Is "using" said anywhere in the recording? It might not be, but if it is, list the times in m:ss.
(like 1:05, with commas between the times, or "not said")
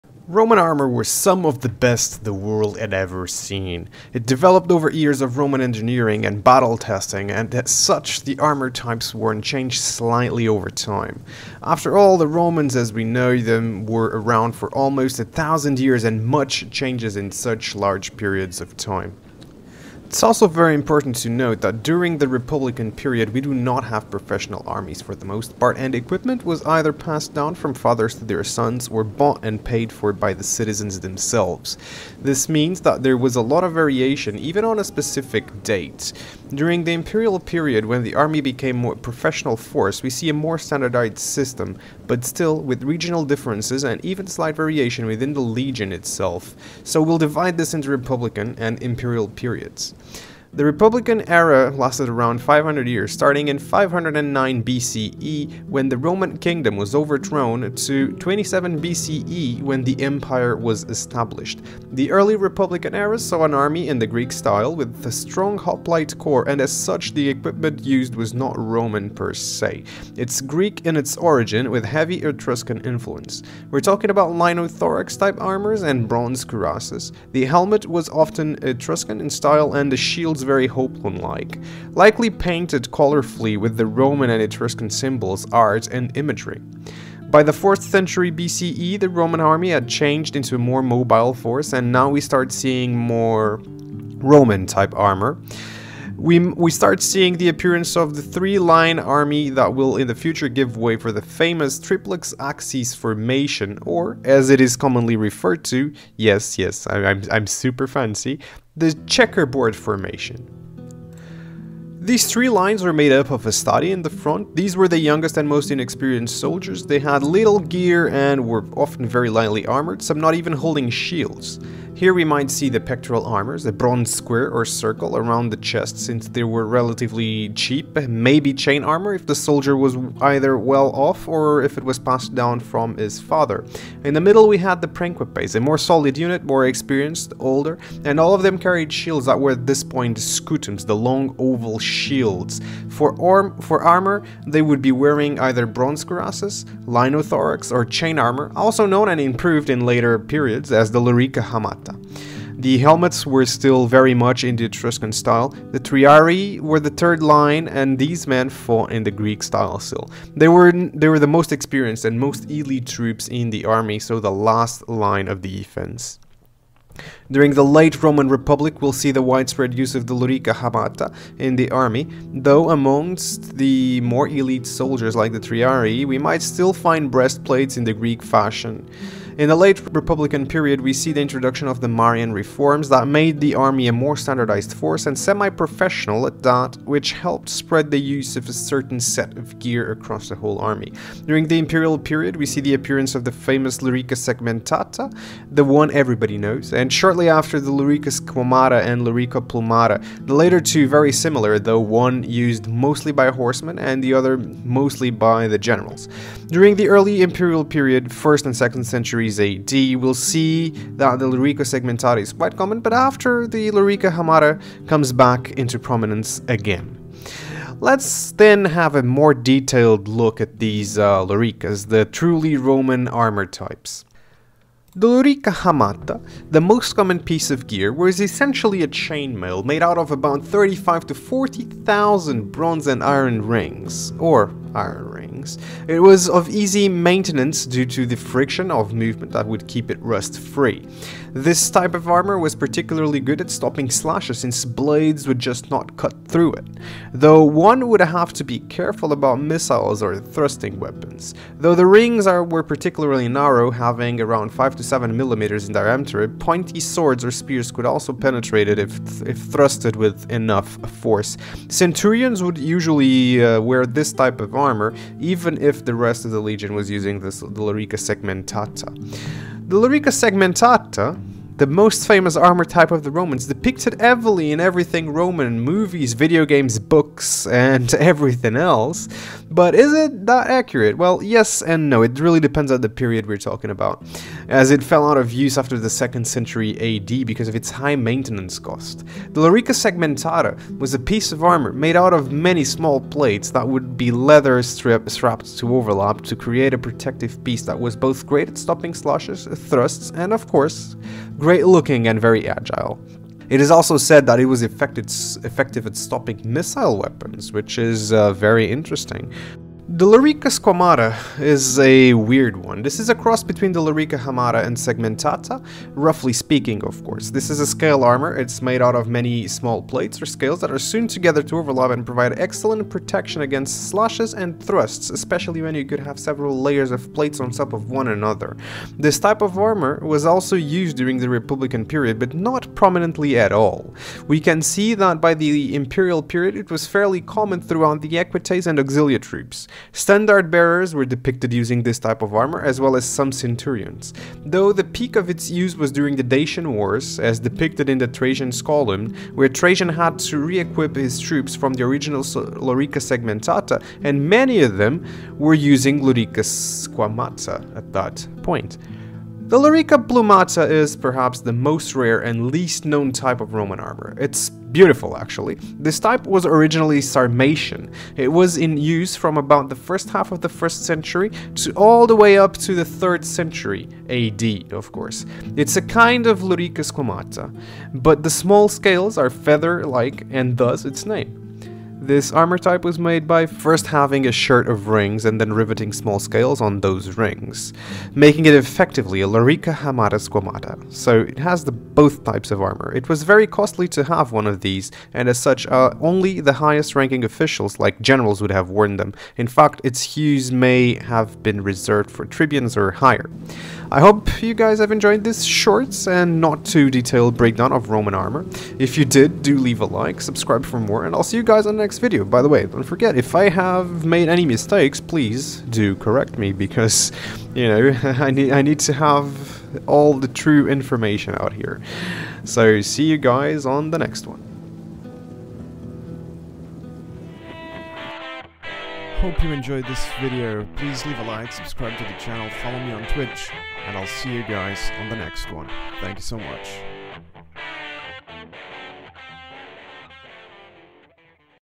4:26, 5:41, 5:55.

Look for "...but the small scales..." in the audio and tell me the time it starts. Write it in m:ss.
6:17.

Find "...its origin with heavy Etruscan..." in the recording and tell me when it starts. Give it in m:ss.
1:10.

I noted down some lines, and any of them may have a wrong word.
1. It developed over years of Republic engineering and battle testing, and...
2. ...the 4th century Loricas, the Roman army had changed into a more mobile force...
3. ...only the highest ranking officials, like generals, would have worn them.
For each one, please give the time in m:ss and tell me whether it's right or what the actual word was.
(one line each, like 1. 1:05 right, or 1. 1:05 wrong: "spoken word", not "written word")
1. 0:04 wrong: "Roman", not "Republic"
2. 1:27 wrong: "BCE", not "Loricas"
3. 6:36 right.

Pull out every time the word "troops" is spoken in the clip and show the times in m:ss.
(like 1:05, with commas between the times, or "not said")
2:42, 5:39, 5:51.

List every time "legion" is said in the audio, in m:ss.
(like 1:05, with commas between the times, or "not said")
0:45, 4:26.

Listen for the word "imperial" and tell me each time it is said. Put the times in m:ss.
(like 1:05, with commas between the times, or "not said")
0:36, 0:48, 3:11, 3:27, 5:35.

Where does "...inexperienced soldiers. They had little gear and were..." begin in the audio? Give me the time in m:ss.
1:55.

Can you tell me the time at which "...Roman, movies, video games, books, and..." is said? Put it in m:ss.
4:35.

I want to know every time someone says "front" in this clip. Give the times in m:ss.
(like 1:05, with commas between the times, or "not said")
1:54.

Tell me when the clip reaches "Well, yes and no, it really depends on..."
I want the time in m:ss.
4:40.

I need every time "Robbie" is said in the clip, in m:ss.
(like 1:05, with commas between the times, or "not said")
not said.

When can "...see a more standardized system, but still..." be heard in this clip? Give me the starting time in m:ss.
0:40.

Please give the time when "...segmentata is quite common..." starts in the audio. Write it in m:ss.
3:31.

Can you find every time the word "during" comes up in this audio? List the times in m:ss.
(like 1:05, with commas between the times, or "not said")
0:21, 0:36, 2:47, 3:11, 3:26, 5:30, 5:45.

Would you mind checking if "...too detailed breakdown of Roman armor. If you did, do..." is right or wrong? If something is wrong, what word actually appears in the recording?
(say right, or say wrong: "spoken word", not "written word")
right.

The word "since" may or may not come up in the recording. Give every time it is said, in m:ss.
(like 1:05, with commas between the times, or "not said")
2:05, 4:04.